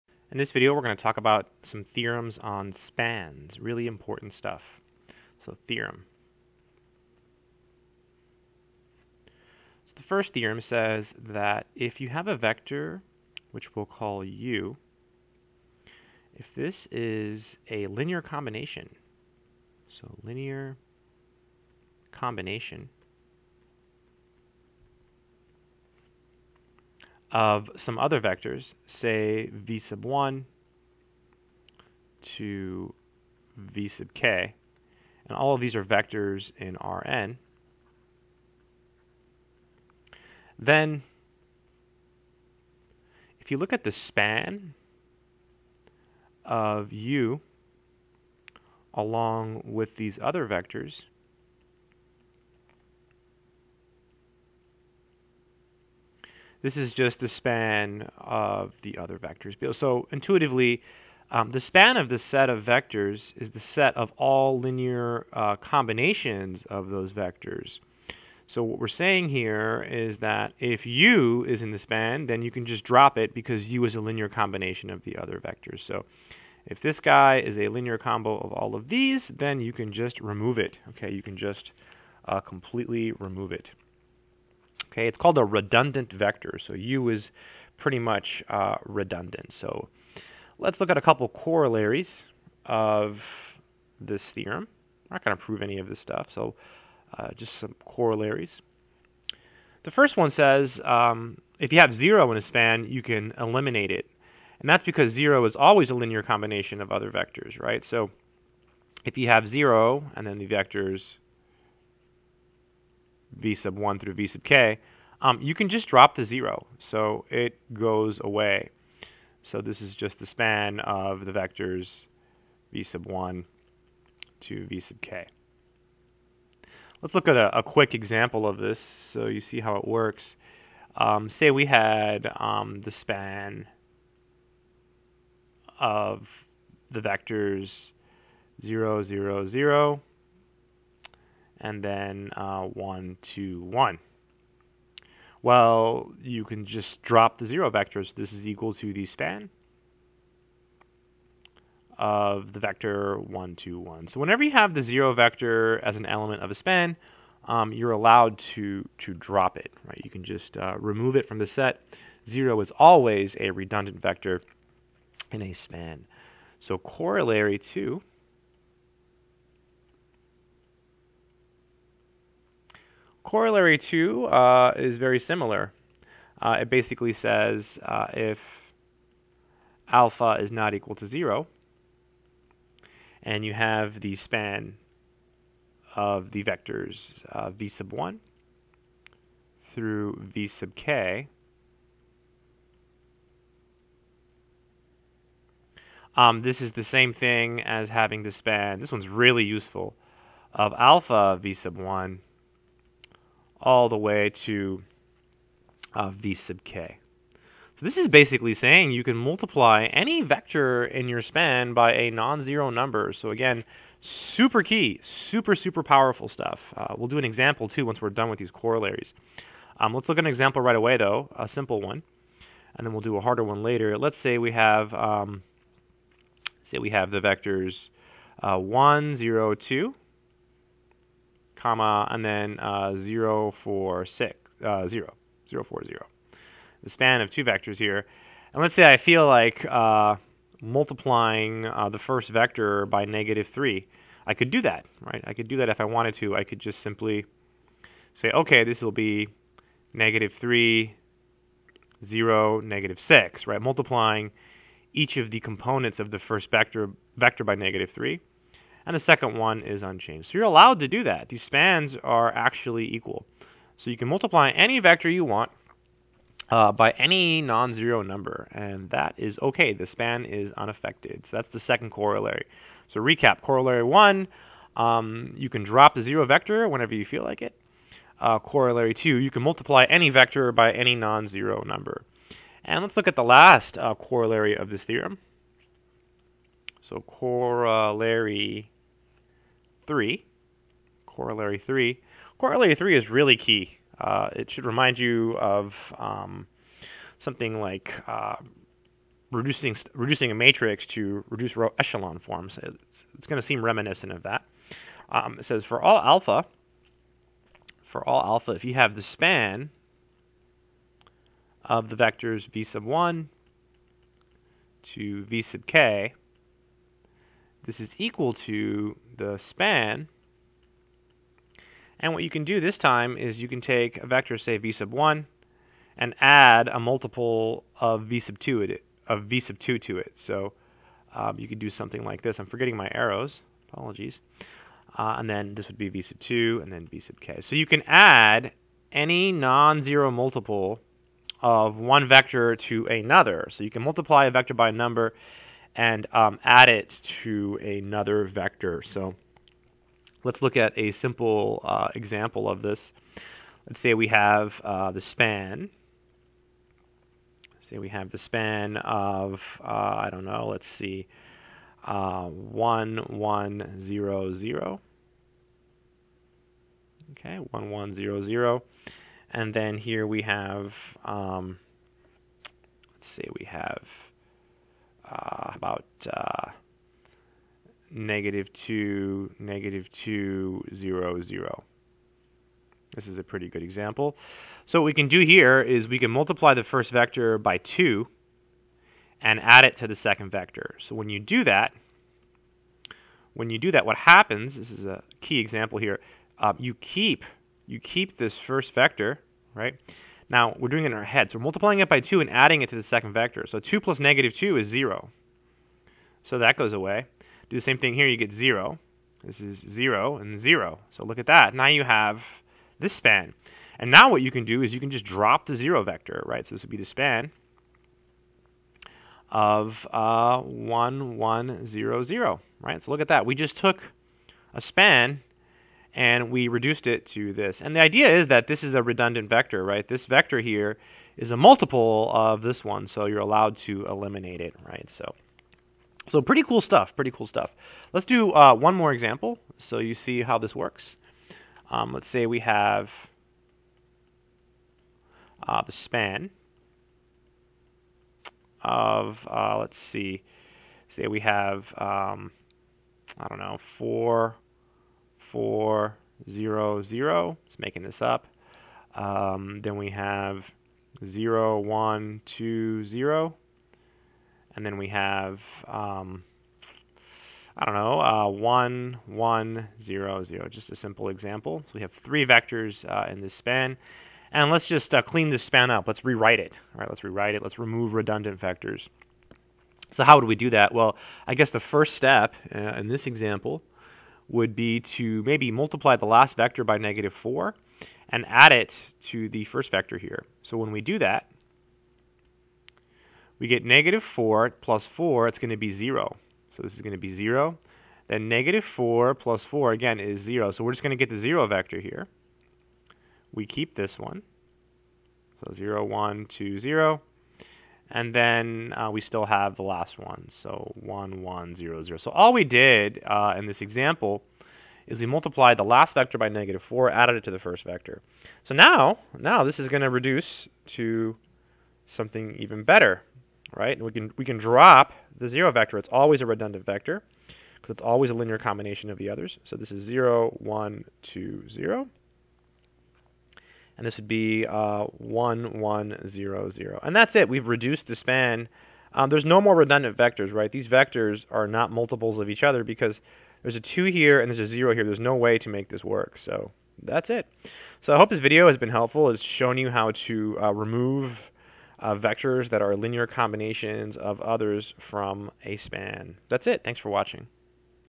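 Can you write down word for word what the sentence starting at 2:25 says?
Well, you can just drop the zero vector.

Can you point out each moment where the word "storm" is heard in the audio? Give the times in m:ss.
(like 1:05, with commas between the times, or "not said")
not said.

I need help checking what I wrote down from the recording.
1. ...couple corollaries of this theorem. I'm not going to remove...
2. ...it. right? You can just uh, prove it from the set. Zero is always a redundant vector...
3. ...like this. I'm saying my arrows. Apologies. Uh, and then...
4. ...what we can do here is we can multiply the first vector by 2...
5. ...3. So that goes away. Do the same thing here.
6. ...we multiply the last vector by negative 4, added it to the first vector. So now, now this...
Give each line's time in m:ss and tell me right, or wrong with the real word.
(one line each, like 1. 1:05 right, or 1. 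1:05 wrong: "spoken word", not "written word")
1. 1:31 wrong: "prove", not "remove"
2. 2:39 wrong: "remove", not "prove"
3. 5:32 wrong: "forgetting", not "saying"
4. 6:24 right
5. 6:44 wrong: "0", not "3"
6. 8:34 right.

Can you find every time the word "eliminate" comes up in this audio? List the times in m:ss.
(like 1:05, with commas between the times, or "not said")
1:43, 7:13.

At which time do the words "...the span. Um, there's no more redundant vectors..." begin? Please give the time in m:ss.
8:57.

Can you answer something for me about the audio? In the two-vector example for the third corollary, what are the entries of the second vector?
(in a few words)
-2, -2, 0, 0.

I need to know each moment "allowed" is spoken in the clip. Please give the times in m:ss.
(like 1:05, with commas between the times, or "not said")
2:37, 4:20, 7:13.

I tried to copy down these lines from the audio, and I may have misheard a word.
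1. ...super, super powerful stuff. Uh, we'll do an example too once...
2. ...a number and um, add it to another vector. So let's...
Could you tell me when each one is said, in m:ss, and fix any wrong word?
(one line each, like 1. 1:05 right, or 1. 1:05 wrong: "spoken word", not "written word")
1. 3:35 right
2. 5:44 right.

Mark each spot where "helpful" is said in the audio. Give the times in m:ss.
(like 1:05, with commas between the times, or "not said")
9:08.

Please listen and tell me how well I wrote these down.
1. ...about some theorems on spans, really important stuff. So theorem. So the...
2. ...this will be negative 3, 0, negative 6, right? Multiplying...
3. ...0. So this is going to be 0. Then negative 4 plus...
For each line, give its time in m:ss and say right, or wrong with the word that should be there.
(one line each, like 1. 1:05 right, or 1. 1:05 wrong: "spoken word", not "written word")
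1. 0:01 right
2. 4:08 right
3. 8:15 right.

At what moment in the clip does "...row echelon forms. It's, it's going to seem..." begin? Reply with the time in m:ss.
5:01.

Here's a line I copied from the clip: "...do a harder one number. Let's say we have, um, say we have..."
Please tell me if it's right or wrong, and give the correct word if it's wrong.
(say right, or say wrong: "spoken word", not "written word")
wrong: "later", not "number".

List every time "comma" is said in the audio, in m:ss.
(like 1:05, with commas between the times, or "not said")
3:51.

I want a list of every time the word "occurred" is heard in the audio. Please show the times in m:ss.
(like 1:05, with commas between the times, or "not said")
not said.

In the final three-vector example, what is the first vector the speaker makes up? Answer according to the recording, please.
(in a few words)
4, 4, 0, 0.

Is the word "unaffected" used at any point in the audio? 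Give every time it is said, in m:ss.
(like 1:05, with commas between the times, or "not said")
4:30.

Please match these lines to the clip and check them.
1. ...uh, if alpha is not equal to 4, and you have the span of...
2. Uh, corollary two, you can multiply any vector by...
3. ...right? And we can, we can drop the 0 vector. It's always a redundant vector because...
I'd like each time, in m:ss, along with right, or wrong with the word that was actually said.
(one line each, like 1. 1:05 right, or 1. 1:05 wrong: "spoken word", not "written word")
1. 2:57 wrong: "0", not "4"
2. 4:38 right
3. 8:43 right.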